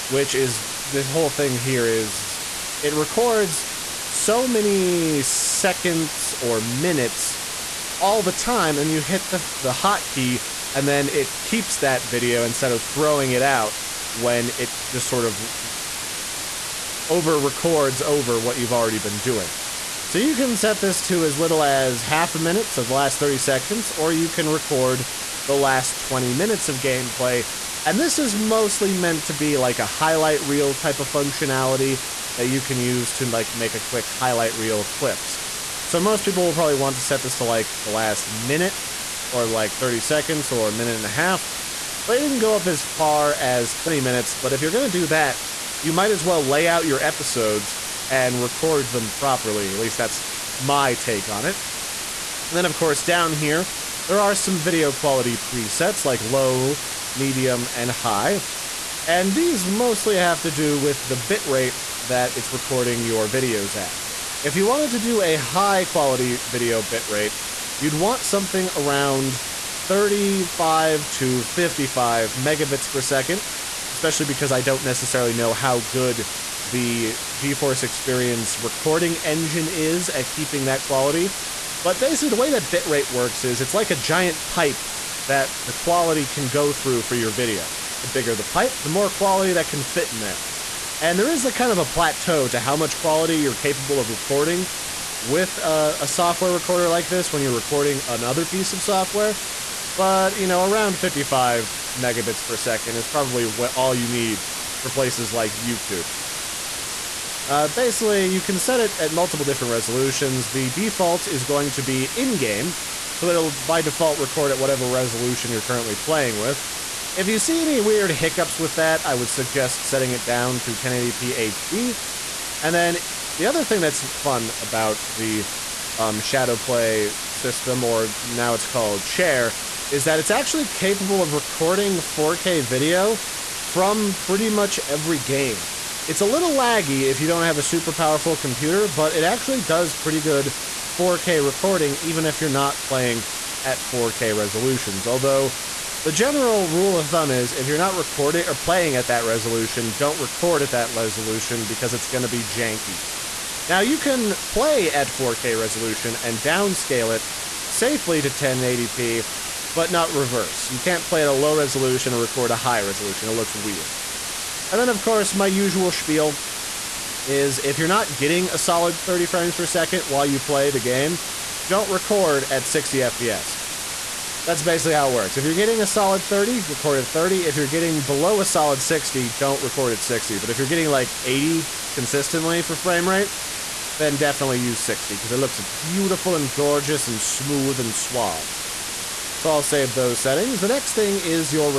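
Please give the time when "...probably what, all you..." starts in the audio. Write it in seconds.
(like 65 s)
103 s.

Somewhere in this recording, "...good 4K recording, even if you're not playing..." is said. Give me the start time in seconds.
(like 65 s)
140 s.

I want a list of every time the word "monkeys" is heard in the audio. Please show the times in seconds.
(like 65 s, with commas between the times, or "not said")
not said.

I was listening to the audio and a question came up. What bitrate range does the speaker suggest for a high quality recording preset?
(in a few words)
35 to 55 megabits per second.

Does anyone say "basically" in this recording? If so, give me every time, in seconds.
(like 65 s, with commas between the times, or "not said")
81 s, 107 s, 174 s.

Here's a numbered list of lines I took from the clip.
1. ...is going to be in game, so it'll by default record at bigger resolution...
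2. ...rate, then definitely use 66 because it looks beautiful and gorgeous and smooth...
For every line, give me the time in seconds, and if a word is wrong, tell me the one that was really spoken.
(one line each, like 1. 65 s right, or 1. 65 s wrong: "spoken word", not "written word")
1. 111 s wrong: "whatever", not "bigger"
2. 183 s wrong: "60", not "66".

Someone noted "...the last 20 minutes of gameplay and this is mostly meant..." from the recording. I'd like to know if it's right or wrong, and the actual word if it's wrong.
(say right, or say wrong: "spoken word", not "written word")
right.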